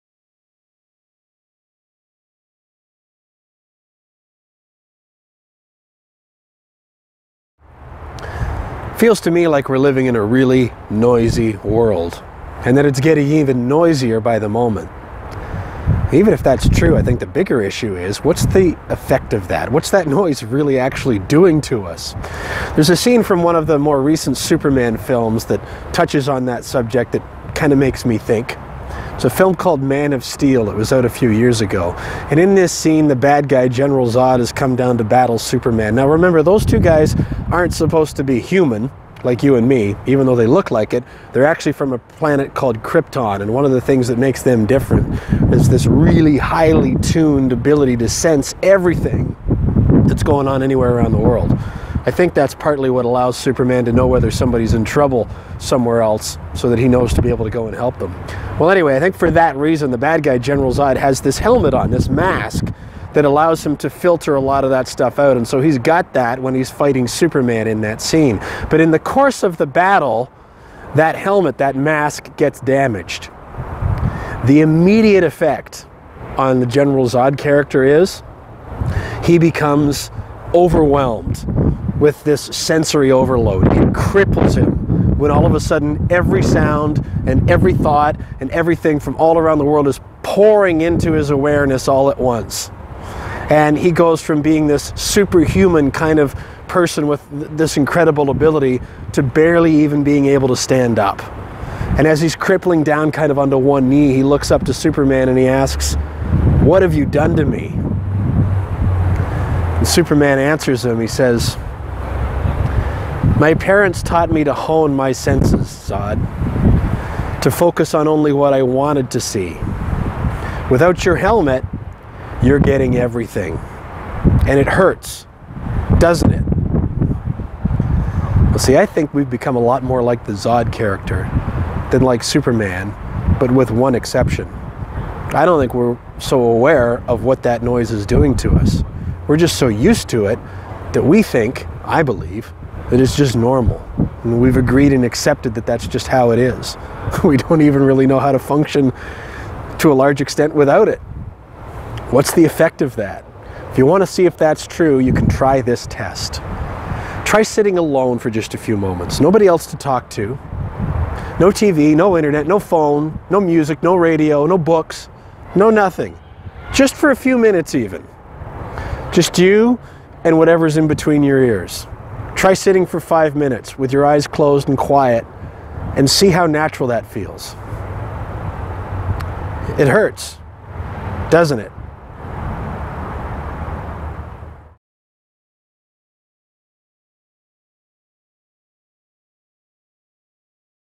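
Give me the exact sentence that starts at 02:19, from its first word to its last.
We're just so used to it that we think, I believe, that it's just normal.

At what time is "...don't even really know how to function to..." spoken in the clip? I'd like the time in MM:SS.
02:27.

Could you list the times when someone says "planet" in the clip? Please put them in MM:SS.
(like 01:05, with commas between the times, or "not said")
00:41.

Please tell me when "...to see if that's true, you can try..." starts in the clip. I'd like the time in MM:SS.
02:34.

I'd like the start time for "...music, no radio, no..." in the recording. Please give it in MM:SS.
02:43.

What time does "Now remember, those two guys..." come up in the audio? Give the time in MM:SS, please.
00:35.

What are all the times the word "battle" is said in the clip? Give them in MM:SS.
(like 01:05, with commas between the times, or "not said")
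00:35, 01:09.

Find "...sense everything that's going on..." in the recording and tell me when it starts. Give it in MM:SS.
00:48.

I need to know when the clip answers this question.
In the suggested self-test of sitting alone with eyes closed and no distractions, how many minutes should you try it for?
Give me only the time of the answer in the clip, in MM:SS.
02:52.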